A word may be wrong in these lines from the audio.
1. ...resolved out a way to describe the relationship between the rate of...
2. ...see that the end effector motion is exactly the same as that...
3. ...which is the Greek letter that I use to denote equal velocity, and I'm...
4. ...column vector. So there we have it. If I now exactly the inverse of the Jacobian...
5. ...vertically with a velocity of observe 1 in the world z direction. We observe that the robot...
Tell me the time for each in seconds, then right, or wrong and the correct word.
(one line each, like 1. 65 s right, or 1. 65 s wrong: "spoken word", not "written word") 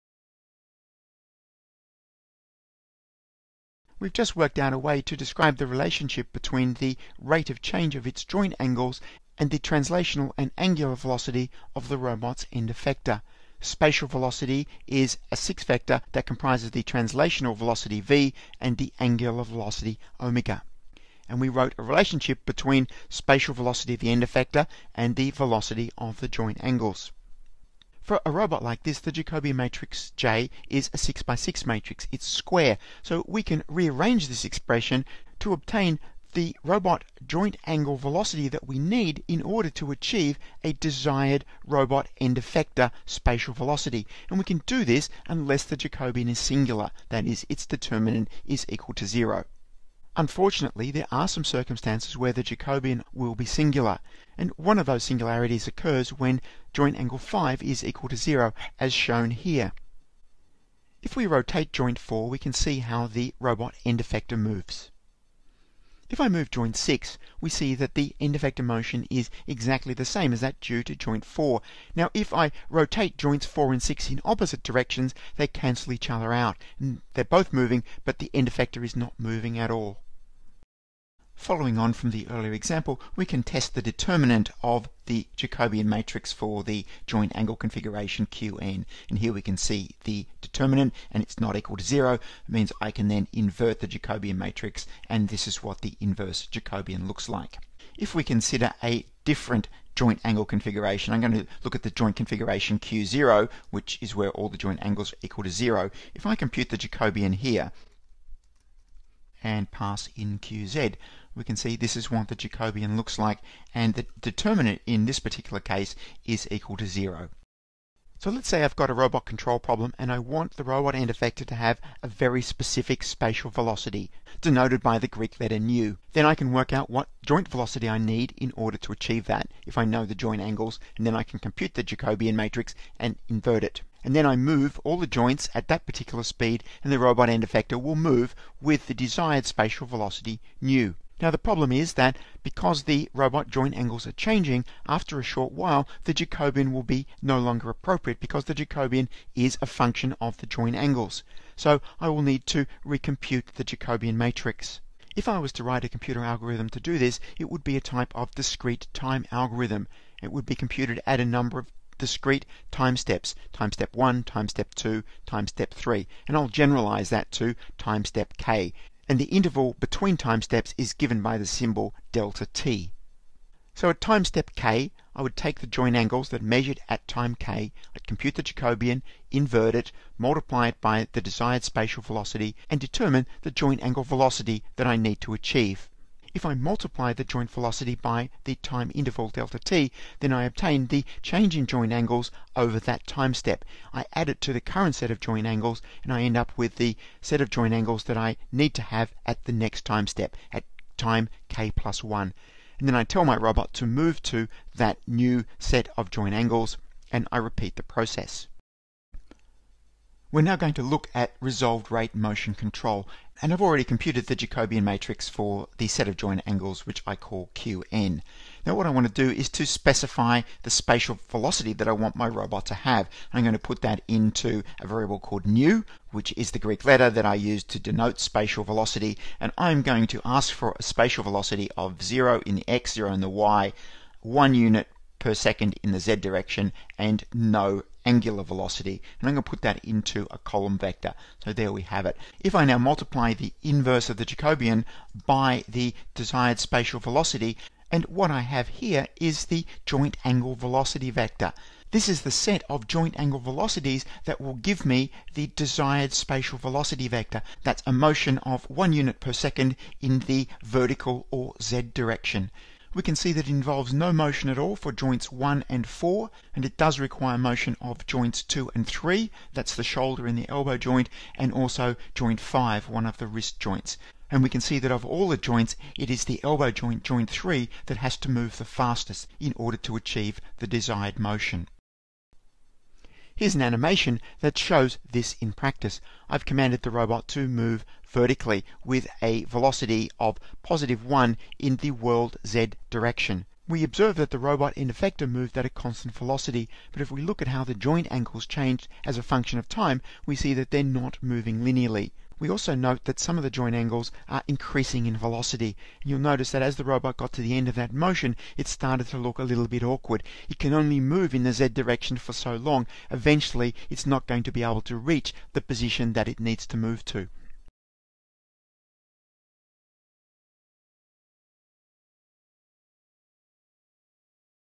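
1. 4 s wrong: "worked", not "resolved"
2. 67 s right
3. 226 s wrong: "spatial", not "equal"
4. 240 s wrong: "multiply", not "exactly"
5. 288 s wrong: "positive", not "observe".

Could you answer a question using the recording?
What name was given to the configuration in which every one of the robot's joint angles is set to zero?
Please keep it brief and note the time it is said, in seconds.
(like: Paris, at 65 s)
Q0, at 102 s.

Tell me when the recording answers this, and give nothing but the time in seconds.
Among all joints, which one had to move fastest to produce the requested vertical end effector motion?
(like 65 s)
277 s.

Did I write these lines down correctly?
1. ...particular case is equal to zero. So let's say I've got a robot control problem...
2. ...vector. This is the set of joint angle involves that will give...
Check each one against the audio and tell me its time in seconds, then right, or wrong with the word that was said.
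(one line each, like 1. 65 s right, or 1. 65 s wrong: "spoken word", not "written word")
1. 115 s right
2. 251 s wrong: "velocities", not "involves".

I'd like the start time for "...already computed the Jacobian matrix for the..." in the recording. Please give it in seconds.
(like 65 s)
213 s.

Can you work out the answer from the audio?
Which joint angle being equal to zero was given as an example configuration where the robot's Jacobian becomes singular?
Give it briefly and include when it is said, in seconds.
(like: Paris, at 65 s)
Joint angle 5, at 56 s.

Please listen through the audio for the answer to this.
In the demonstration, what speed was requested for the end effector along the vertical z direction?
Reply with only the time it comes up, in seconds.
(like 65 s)
234 s.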